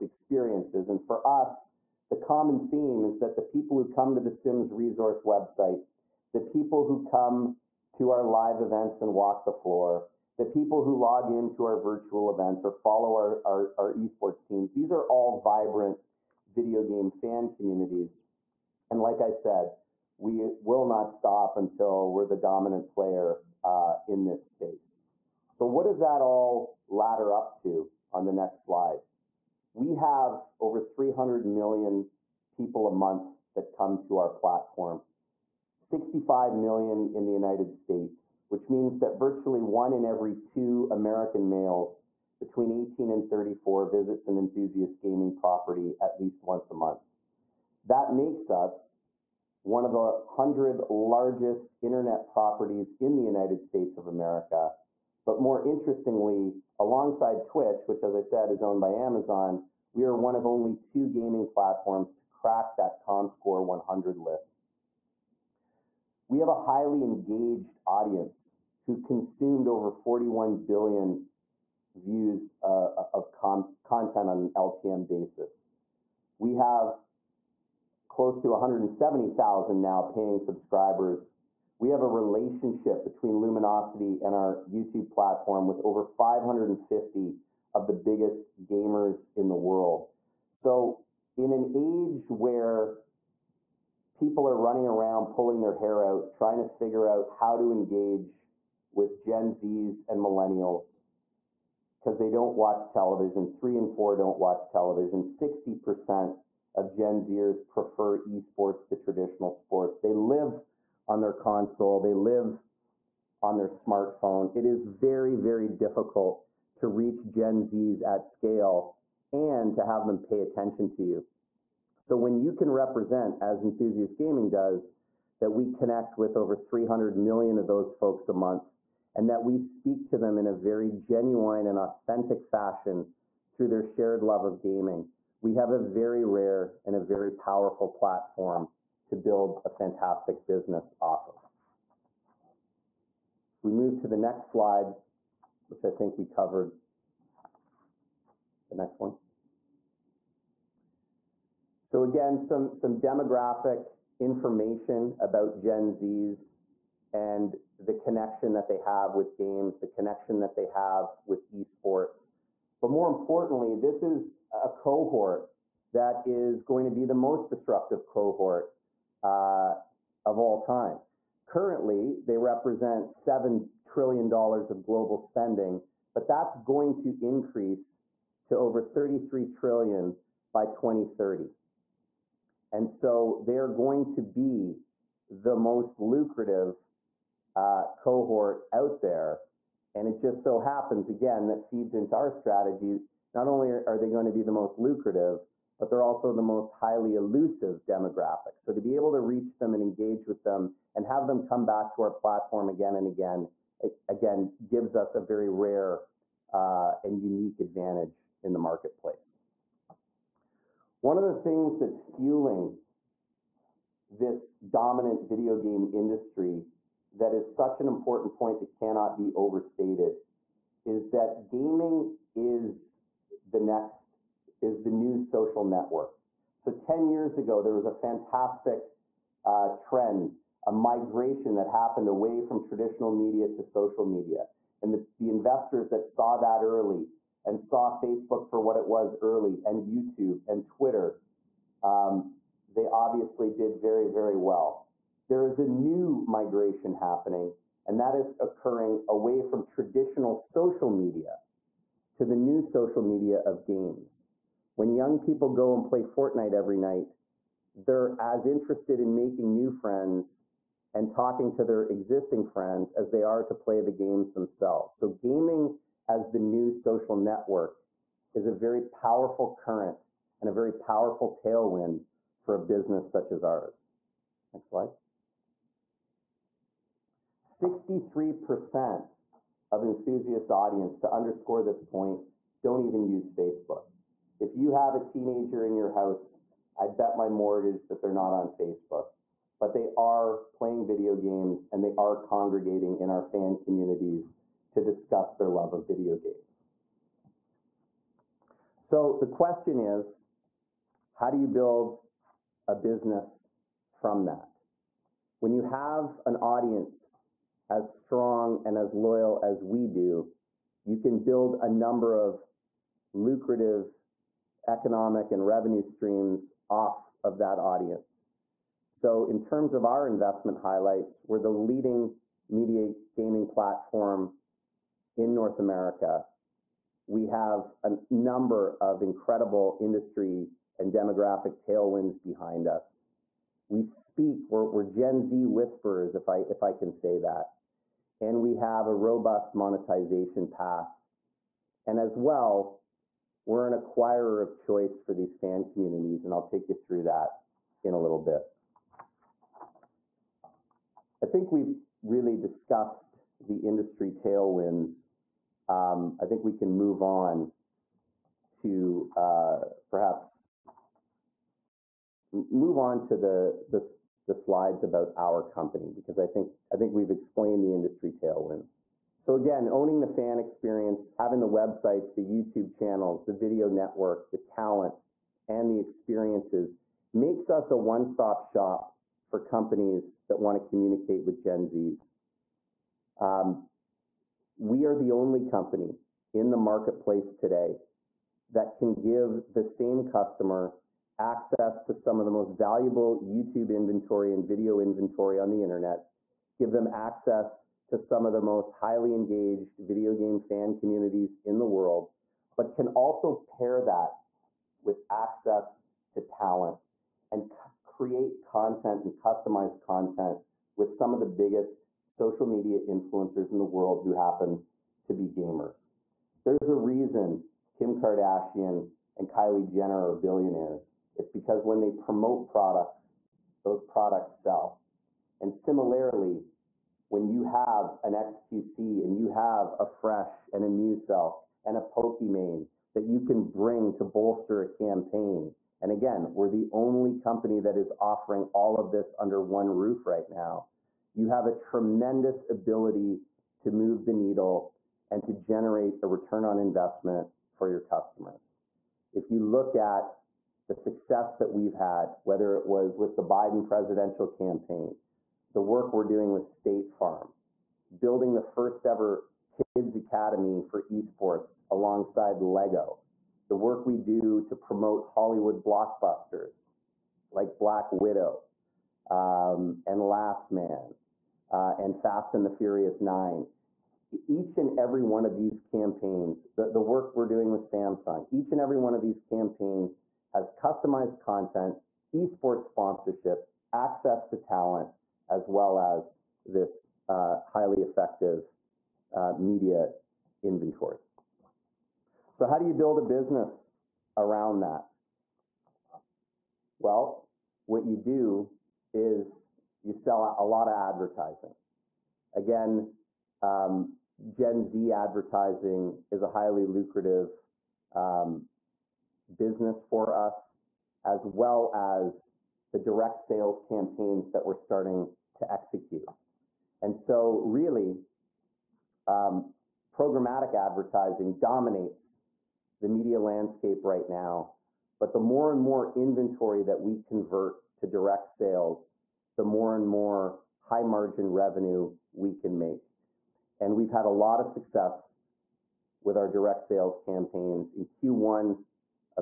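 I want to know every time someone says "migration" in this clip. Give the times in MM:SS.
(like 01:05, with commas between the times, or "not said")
03:50, 04:06.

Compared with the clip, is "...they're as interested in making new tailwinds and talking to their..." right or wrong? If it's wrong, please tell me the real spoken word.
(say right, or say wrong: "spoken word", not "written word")
wrong: "friends", not "tailwinds".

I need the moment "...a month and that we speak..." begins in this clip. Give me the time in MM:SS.
02:08.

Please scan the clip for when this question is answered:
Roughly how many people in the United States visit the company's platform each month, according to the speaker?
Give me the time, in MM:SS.
00:35.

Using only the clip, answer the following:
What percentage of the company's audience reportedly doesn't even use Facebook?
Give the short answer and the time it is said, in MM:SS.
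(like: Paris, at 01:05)
63%, at 04:37.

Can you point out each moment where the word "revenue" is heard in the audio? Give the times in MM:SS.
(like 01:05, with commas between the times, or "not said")
05:15, 08:51.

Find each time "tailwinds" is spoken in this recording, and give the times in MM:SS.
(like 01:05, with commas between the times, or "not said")
04:31, 05:31, 05:54, 06:08.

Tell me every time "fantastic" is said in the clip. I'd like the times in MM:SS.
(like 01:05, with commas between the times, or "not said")
02:19, 03:47.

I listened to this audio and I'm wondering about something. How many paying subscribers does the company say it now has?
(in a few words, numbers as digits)
170,000.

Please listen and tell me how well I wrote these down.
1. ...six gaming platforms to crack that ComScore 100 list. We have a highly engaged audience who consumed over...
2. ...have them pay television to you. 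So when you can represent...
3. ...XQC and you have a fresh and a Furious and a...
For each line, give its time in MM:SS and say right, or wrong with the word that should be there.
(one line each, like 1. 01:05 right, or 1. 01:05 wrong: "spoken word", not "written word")
1. 01:00 wrong: "two", not "six"
2. 01:59 wrong: "attention", not "television"
3. 07:08 wrong: "Muselk", not "Furious".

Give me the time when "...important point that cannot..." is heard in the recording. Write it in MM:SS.
03:37.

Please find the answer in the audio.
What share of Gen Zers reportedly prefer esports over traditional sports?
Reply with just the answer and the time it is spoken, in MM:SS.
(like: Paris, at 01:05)
60%, at 01:45.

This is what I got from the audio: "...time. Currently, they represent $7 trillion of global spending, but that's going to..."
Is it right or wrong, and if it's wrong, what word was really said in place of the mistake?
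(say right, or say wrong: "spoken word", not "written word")
right.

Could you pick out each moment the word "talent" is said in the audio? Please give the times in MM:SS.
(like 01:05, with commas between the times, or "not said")
06:14, 06:46, 08:04.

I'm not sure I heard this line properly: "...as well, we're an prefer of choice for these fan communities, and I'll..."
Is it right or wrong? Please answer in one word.
wrong.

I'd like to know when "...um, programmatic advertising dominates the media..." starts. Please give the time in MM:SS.
08:39.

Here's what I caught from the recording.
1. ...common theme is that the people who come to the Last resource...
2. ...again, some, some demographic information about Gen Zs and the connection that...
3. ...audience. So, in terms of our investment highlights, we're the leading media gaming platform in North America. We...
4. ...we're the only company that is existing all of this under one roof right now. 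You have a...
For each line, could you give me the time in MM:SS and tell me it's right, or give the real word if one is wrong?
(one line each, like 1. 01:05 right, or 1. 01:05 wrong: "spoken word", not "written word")
1. 00:02 wrong: "Sims", not "Last"
2. 02:32 right
3. 05:17 right
4. 07:16 wrong: "offering", not "existing".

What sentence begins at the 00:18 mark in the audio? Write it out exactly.
And like I said, we will not stop until we're the dominant player uh, in this space.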